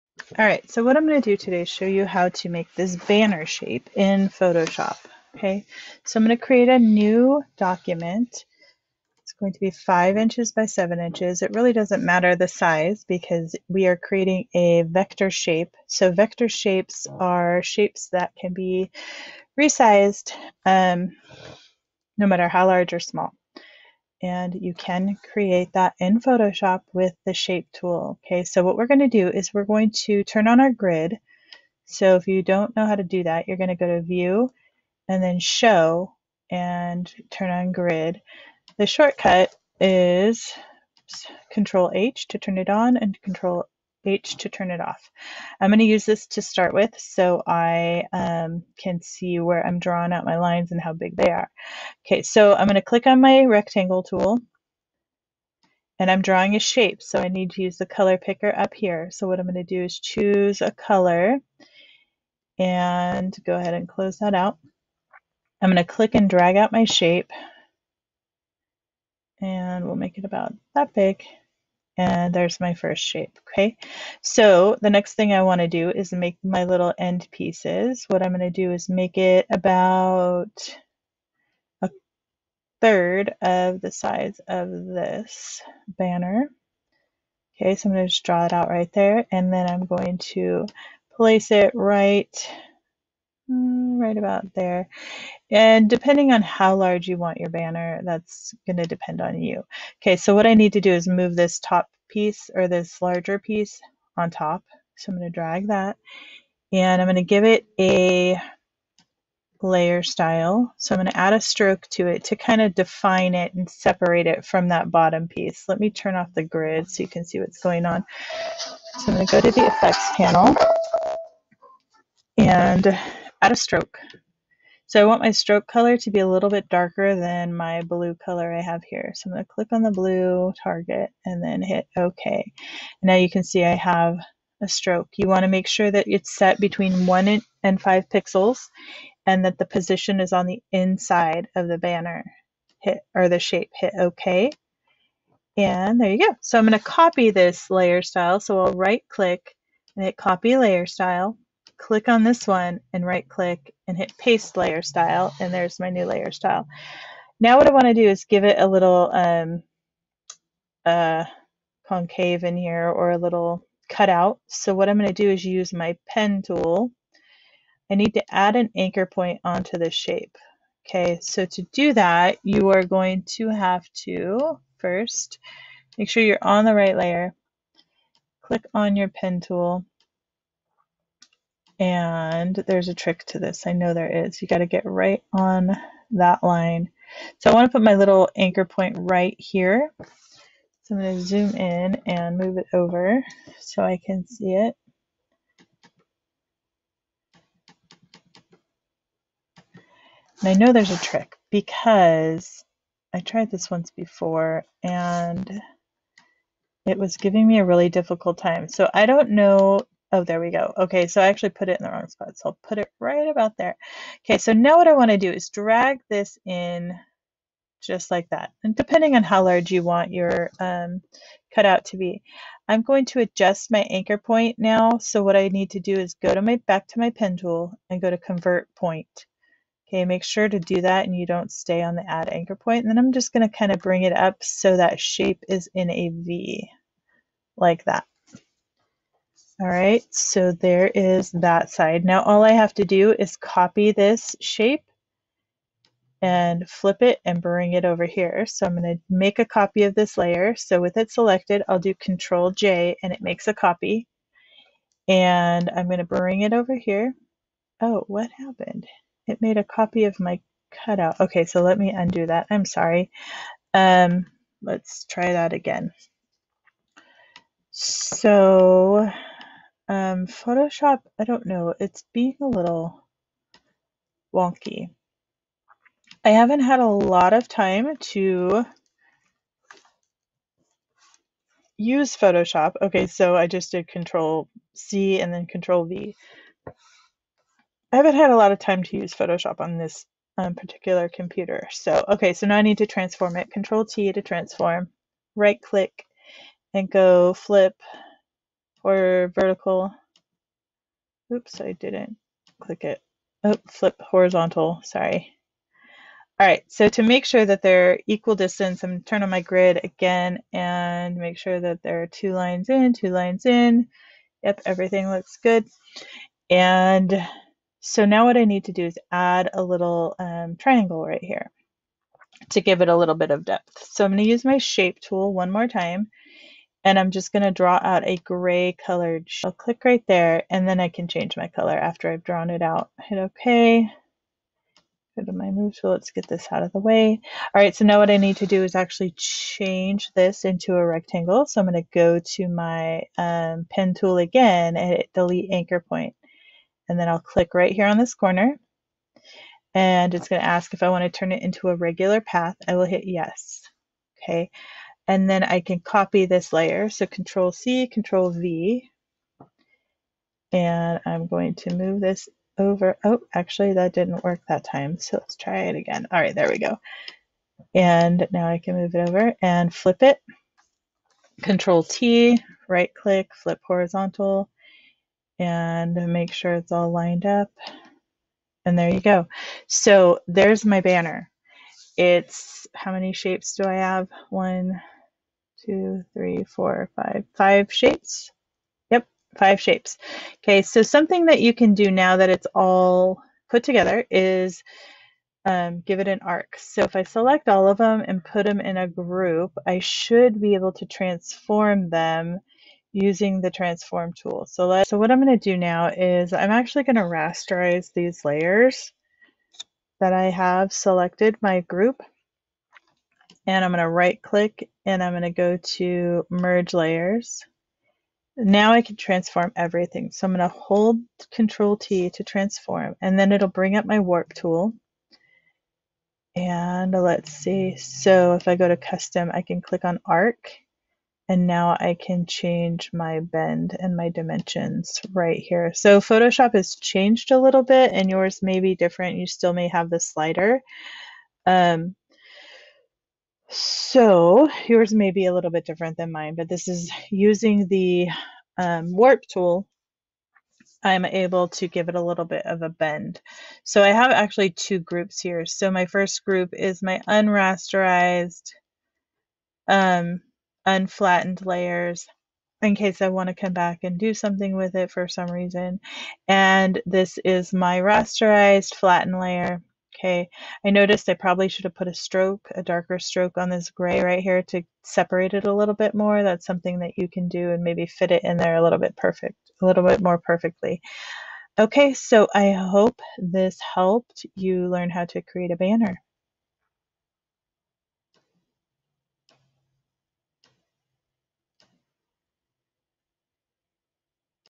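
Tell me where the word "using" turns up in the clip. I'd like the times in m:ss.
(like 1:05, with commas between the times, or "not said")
6:42, 7:27.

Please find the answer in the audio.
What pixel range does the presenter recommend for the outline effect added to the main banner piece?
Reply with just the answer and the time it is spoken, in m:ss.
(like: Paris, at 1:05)
1 to 5 pixels, at 2:16.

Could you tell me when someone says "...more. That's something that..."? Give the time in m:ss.
7:55.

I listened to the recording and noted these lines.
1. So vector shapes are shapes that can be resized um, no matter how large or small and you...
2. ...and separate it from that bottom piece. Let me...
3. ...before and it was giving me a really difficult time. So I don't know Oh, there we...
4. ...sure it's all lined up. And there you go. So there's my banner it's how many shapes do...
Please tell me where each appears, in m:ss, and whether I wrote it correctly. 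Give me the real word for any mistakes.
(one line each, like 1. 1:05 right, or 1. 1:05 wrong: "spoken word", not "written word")
1. 0:15 right
2. 1:53 right
3. 3:23 right
4. 6:16 right.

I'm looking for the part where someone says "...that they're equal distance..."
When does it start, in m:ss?
5:07.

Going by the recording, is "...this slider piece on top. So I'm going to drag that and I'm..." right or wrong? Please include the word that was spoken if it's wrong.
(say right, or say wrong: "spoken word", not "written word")
wrong: "larger", not "slider".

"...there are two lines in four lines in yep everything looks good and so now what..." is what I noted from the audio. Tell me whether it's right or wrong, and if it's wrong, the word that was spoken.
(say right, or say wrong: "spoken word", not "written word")
wrong: "two", not "four".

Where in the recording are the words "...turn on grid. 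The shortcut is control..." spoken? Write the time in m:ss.
0:37.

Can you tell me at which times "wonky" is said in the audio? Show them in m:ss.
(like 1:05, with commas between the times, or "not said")
4:34.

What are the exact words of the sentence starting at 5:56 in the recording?
So control C, control V, and I'm going to move this over.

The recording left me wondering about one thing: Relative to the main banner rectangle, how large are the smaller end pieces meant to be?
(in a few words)
A third.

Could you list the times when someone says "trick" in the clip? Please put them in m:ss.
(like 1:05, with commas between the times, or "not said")
3:02, 3:21.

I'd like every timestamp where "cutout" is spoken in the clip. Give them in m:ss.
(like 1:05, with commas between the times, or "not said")
2:43, 3:41, 4:20.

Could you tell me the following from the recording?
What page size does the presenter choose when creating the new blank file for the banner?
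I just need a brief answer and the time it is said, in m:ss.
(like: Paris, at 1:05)
5 inches by 7 inches, at 0:09.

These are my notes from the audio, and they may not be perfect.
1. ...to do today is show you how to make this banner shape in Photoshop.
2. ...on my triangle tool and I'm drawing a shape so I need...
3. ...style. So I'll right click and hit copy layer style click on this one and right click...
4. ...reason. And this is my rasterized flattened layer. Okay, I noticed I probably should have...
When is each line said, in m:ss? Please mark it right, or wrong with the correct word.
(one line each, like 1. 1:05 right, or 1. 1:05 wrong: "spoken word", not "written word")
1. 0:01 right
2. 0:53 wrong: "rectangle", not "triangle"
3. 2:28 right
4. 7:45 right.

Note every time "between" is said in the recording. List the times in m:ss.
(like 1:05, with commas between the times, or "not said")
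2:16.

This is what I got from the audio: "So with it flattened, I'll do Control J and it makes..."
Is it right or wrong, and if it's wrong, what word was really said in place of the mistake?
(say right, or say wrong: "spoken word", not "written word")
wrong: "selected", not "flattened".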